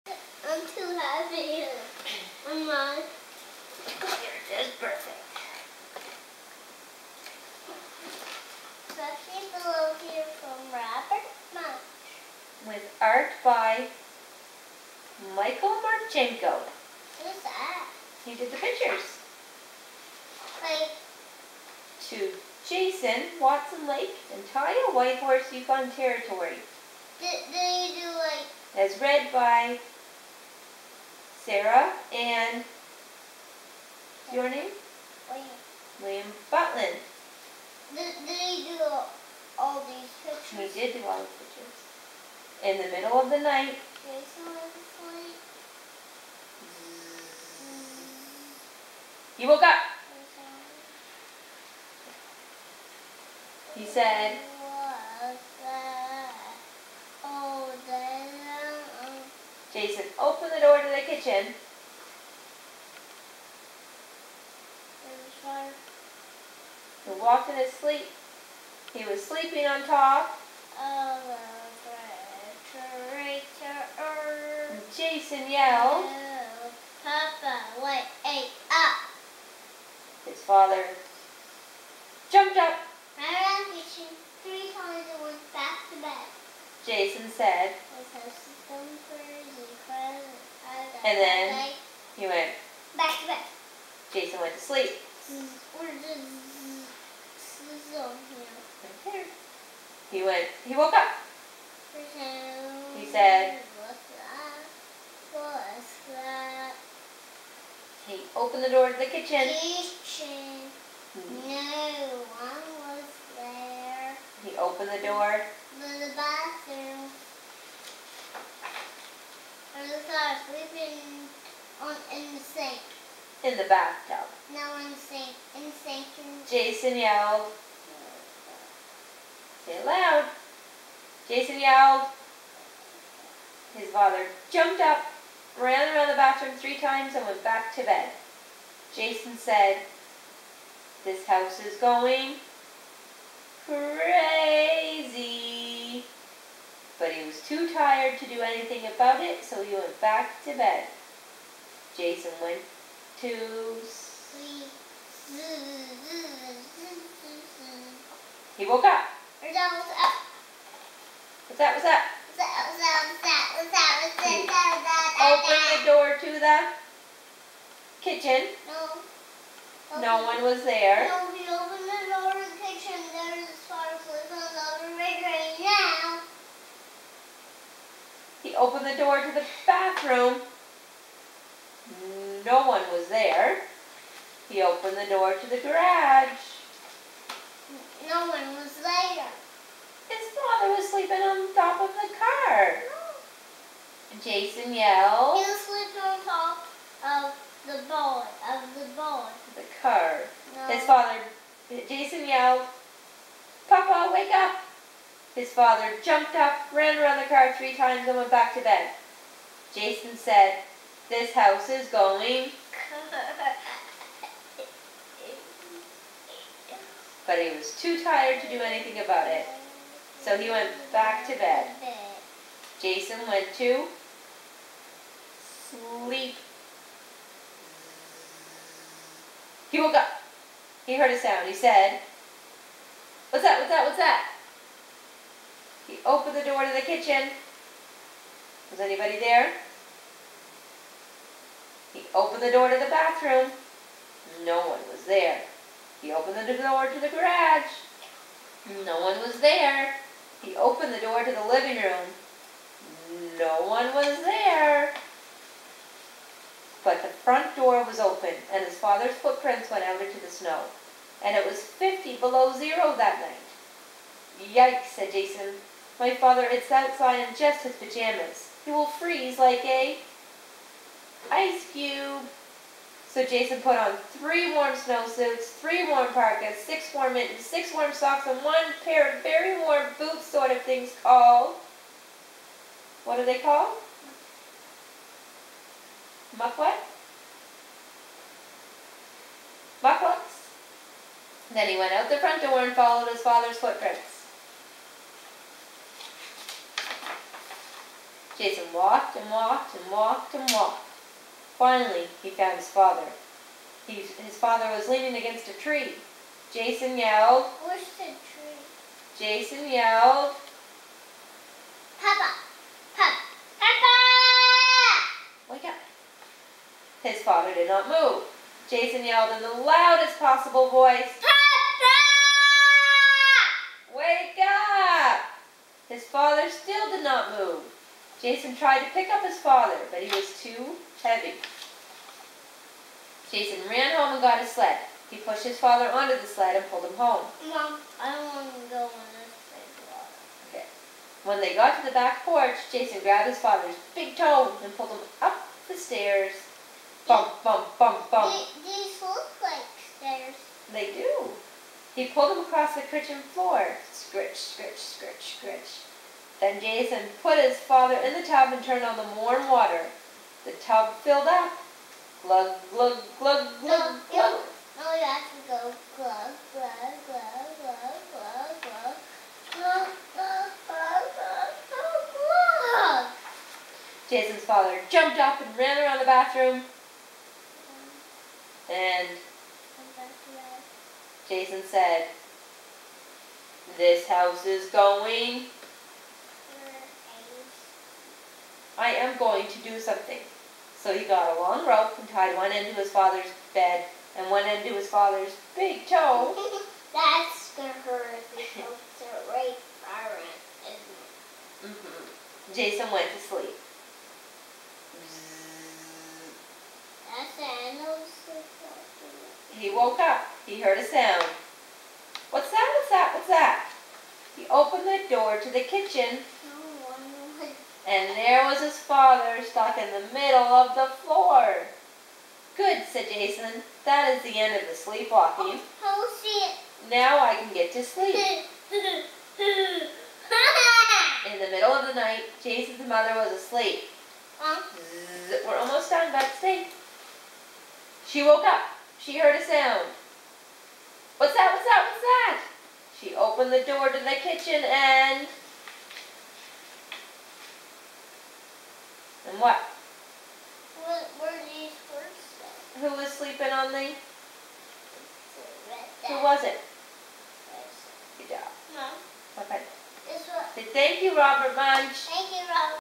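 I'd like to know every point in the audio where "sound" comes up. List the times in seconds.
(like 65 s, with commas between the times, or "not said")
231 s, 410 s, 439 s.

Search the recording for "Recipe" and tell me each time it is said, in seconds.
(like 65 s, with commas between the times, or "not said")
8 s.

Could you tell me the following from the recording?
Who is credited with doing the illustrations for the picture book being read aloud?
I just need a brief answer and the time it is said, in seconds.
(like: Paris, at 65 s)
Michael Martchenko, at 15 s.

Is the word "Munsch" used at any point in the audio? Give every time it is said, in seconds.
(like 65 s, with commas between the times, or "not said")
11 s, 461 s.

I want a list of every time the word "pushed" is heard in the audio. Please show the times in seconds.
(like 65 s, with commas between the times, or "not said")
335 s.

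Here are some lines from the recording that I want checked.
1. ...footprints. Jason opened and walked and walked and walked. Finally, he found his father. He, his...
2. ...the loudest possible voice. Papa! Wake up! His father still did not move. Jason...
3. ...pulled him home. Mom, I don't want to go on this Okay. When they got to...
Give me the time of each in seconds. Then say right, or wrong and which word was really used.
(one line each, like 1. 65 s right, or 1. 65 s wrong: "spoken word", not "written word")
1. 293 s wrong: "walked", not "opened"
2. 319 s right
3. 336 s right.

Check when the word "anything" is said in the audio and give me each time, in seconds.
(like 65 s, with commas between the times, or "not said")
148 s, 218 s.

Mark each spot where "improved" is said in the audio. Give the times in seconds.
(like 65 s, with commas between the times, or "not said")
not said.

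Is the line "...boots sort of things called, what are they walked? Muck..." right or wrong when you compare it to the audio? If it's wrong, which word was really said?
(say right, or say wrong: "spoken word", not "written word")
wrong: "called", not "walked".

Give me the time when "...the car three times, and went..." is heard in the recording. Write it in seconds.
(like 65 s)
207 s.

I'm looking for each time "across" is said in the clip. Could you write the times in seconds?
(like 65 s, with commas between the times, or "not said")
352 s.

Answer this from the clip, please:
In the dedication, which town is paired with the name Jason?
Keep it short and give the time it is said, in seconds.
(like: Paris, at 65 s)
Watson Lake, at 23 s.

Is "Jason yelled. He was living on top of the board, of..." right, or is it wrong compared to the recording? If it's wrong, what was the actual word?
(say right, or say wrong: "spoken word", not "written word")
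wrong: "sleeping", not "living".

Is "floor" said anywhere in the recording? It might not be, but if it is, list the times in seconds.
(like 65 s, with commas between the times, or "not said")
353 s, 421 s.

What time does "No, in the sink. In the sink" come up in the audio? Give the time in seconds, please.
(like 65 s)
124 s.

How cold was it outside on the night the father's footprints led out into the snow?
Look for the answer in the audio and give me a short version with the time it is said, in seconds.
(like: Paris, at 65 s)
50 below zero, at 261 s.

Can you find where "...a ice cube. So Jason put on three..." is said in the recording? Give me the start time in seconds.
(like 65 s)
269 s.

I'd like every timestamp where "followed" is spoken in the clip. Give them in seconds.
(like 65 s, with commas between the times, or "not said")
292 s.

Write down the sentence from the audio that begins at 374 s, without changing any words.
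Jason's father jumped up and ran around the bathroom.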